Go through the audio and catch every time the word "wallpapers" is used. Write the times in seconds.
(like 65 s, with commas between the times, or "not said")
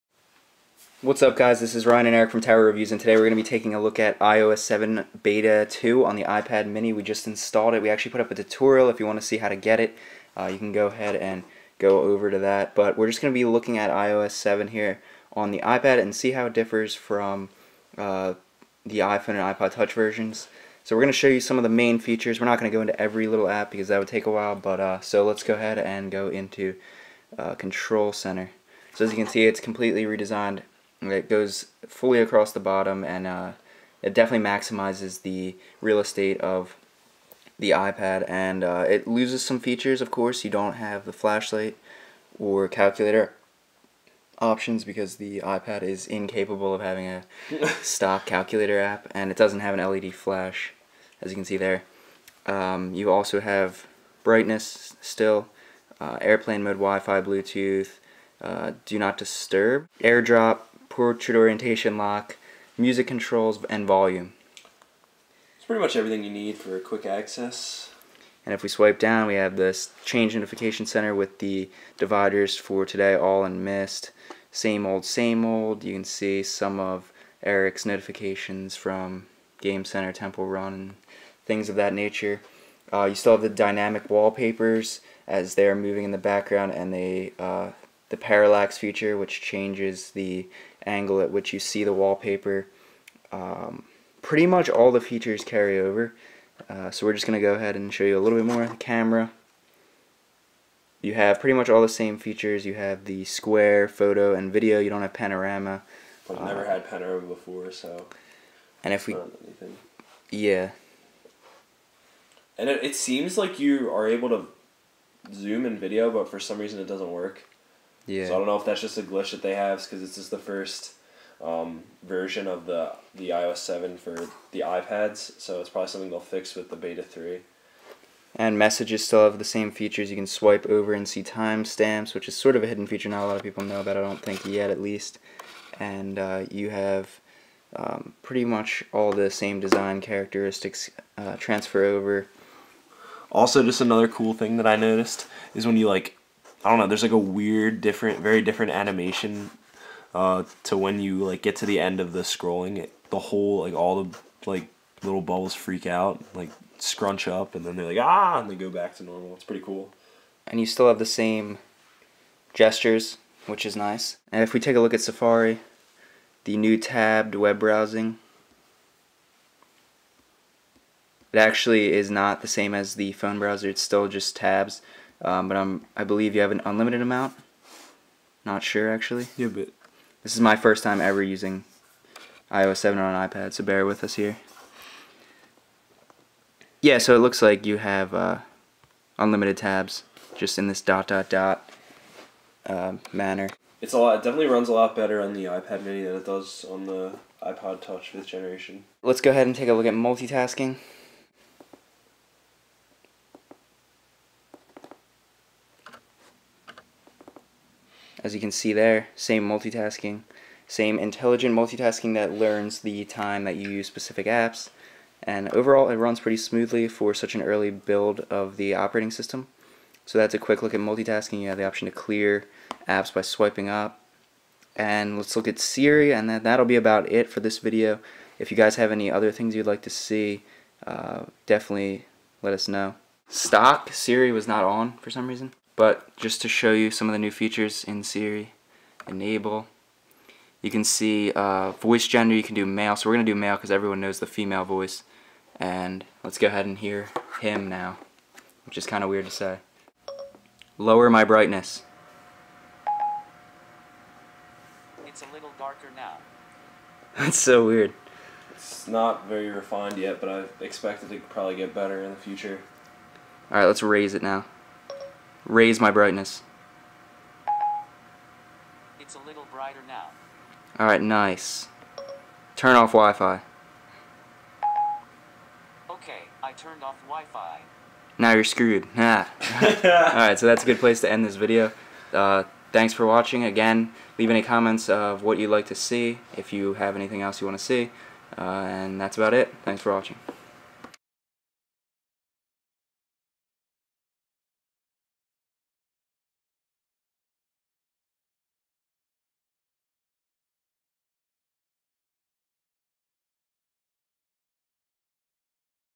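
84 s, 91 s.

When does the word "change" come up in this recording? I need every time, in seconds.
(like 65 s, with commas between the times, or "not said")
70 s, 89 s.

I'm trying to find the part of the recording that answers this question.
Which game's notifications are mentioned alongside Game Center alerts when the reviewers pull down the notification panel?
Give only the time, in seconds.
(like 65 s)
80 s.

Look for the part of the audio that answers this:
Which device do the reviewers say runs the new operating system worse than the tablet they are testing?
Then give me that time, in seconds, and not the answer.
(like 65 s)
197 s.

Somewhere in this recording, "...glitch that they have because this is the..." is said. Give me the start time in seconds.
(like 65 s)
119 s.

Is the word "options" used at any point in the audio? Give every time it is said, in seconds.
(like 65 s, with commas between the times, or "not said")
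44 s, 221 s.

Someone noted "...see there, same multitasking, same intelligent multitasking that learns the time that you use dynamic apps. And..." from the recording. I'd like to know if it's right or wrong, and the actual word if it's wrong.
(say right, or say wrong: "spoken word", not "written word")
wrong: "specific", not "dynamic".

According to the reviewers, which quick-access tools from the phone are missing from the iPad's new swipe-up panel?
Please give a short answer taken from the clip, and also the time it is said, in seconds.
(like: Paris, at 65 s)
flashlight or calculator, at 41 s.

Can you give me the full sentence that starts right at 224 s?
And let's look at Siri, and that, that'll be about it for this video.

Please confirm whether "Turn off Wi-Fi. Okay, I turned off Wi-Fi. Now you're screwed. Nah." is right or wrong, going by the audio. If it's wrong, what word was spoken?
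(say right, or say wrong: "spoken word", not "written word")
right.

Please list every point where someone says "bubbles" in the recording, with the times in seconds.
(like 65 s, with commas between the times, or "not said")
155 s.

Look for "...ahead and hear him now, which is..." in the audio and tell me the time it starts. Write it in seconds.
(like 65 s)
246 s.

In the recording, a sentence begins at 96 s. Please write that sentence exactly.
Uh, so we're just going to go ahead and show you a little bit more.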